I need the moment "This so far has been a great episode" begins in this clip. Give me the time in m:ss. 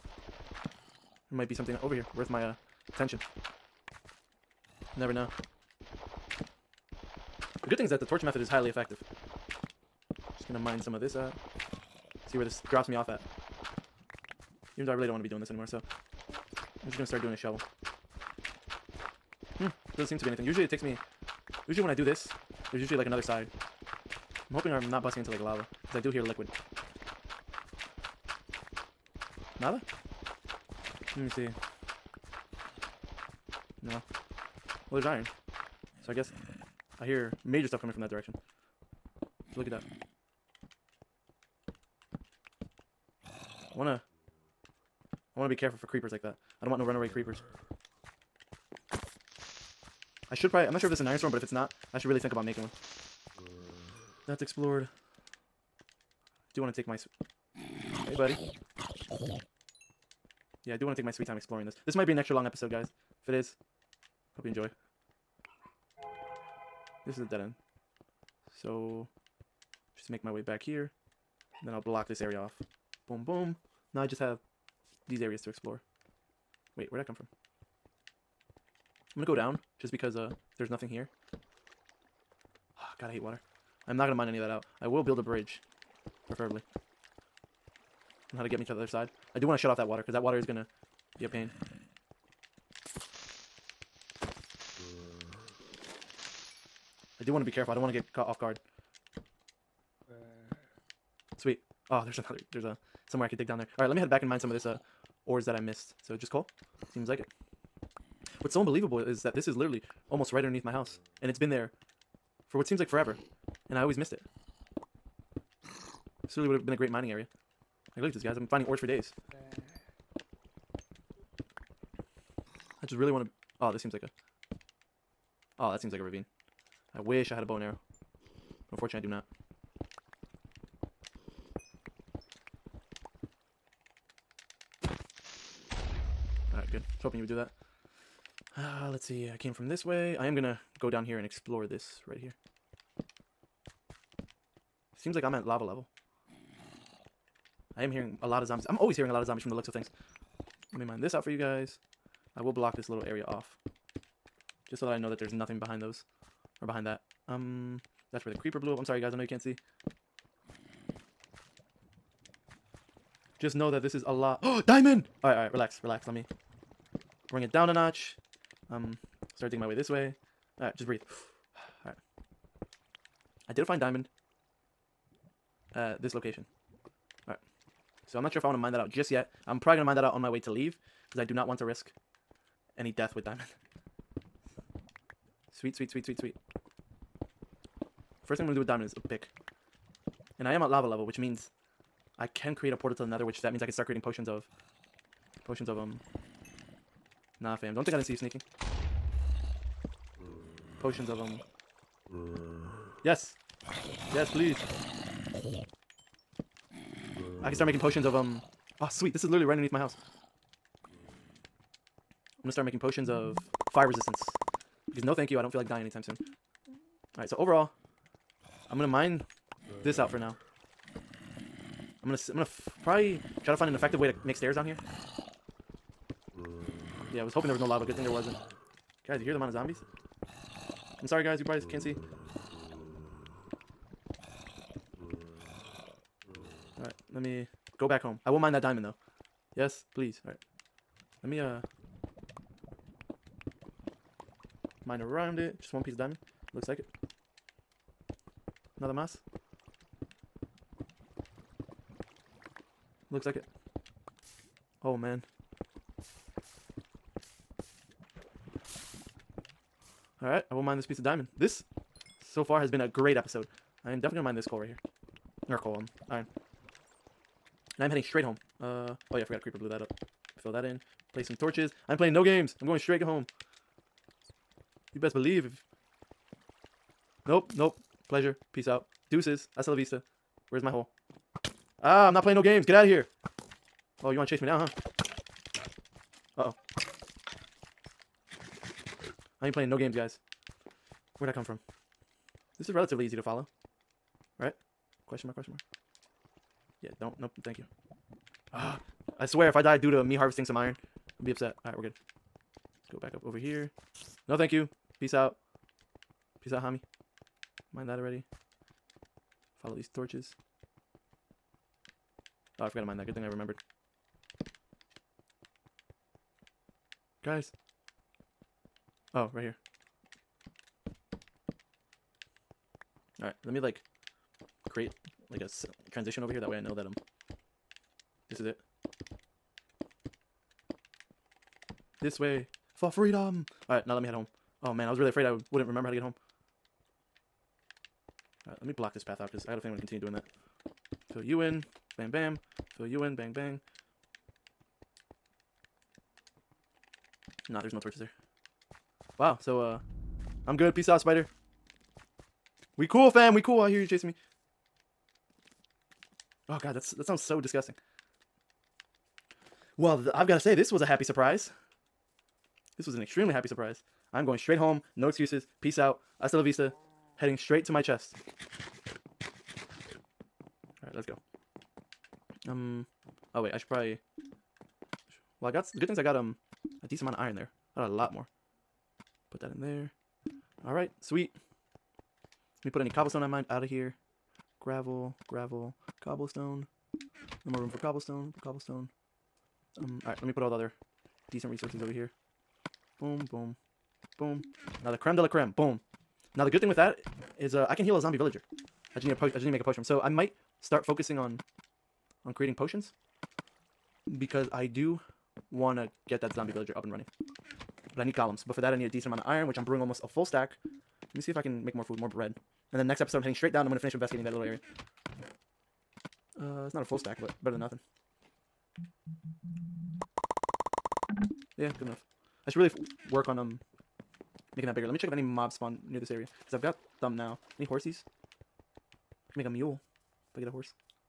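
4:21.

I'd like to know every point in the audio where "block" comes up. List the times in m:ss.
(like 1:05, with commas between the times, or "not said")
1:11, 2:32, 5:38.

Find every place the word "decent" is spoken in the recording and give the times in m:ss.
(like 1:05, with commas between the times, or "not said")
6:16, 6:31, 6:48.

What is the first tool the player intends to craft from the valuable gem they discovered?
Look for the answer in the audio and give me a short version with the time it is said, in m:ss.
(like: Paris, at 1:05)
a pick, at 3:08.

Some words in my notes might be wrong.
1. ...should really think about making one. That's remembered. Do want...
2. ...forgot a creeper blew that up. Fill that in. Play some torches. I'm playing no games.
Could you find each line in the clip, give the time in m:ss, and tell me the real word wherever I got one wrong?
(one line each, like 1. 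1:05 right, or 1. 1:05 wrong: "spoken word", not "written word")
1. 0:51 wrong: "explored", not "remembered"
2. 4:29 right.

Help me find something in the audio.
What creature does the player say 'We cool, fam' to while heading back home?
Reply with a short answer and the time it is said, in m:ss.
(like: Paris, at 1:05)
spider, at 5:50.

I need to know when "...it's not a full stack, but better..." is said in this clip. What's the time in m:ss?
6:56.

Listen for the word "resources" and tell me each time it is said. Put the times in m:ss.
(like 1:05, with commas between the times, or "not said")
6:31.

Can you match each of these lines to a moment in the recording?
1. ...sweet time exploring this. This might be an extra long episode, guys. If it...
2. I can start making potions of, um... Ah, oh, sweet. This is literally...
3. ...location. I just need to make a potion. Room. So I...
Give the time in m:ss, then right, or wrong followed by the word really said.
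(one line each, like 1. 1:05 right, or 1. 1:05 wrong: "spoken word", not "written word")
1. 1:01 right
2. 3:27 right
3. 6:39 wrong: "potion", not "location".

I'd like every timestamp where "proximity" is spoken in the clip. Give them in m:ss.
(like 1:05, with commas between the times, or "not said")
not said.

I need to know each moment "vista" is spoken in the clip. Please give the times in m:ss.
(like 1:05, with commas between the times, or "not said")
4:39, 6:06.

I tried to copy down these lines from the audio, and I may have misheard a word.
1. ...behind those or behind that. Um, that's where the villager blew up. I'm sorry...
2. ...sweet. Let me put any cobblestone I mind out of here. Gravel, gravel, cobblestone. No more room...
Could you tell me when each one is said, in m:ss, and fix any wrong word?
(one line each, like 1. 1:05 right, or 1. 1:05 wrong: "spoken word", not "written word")
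1. 2:35 wrong: "creeper", not "villager"
2. 6:21 right.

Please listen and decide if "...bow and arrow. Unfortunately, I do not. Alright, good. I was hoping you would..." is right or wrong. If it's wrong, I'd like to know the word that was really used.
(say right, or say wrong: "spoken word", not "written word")
right.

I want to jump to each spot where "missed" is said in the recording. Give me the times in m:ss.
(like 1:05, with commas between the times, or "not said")
1:45, 1:53.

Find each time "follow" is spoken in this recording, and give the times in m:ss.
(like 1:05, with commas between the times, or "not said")
4:53, 5:09.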